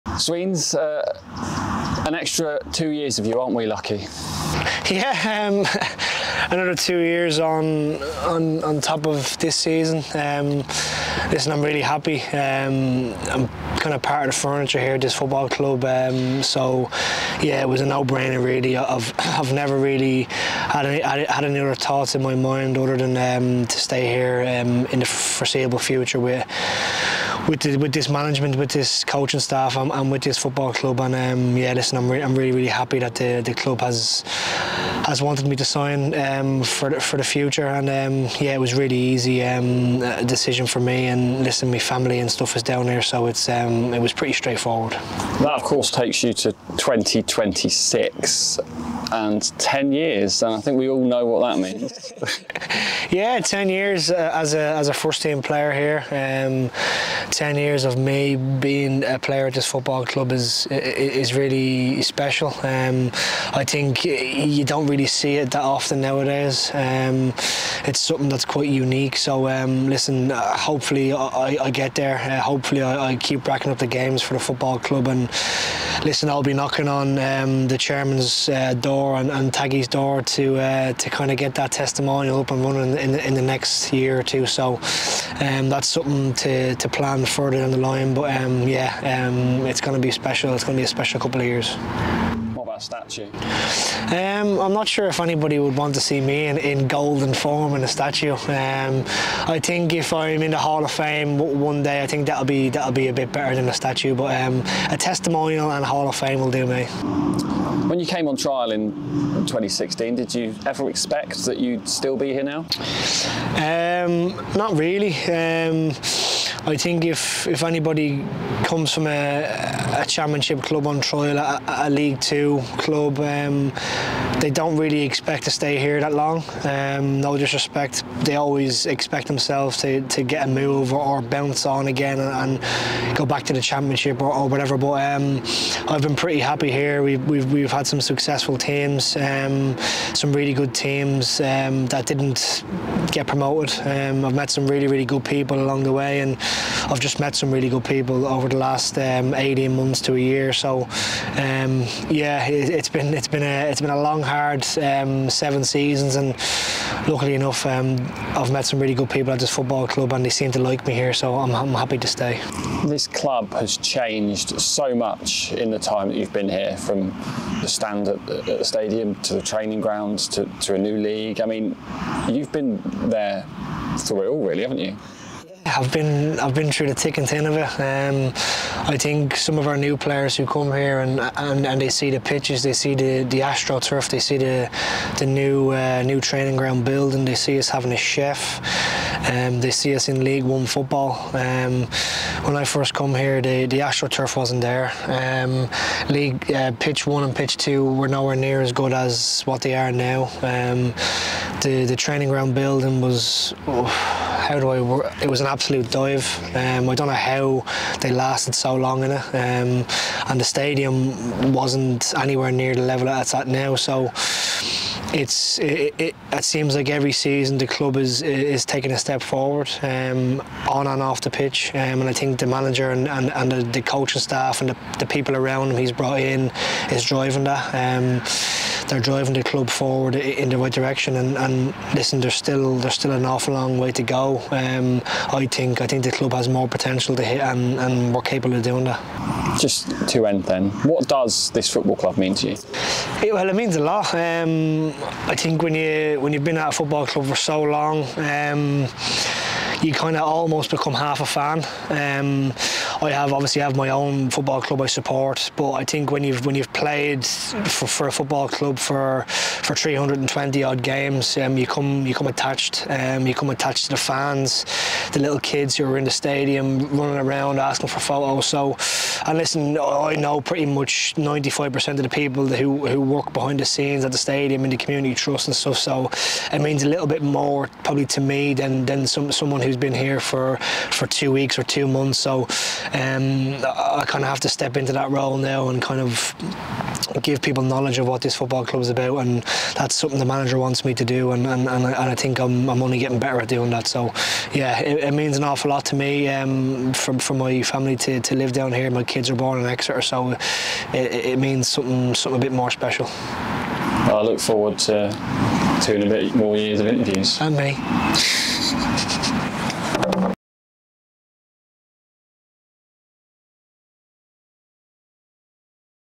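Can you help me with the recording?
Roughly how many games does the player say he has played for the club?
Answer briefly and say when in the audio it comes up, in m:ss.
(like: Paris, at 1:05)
320, at 4:19.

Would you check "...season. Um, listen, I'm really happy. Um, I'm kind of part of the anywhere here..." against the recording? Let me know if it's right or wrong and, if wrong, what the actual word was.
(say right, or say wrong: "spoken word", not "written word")
wrong: "furniture", not "anywhere".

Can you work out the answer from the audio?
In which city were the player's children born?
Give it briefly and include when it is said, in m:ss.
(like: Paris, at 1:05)
Exeter, at 4:59.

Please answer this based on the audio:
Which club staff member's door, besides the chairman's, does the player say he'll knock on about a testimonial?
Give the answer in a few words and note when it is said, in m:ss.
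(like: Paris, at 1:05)
Taggy, at 1:19.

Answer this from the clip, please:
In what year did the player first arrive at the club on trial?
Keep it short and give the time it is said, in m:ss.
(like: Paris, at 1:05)
2016, at 1:49.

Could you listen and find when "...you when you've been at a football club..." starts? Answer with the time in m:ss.
4:05.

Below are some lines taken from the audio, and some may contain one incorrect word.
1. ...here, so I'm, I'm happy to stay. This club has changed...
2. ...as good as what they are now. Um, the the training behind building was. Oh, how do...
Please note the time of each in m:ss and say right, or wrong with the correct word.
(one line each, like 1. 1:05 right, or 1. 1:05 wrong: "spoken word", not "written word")
1. 2:40 right
2. 3:18 wrong: "ground", not "behind".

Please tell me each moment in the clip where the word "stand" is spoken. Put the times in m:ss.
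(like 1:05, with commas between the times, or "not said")
2:47.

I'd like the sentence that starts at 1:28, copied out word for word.
But um, yeah, um, it's going to be special.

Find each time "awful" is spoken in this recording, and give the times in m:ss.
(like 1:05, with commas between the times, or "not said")
3:53, 4:55.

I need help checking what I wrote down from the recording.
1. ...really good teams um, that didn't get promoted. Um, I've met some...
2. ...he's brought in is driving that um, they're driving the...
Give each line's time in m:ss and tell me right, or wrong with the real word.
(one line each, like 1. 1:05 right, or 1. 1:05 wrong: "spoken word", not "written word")
1. 2:20 right
2. 3:45 right.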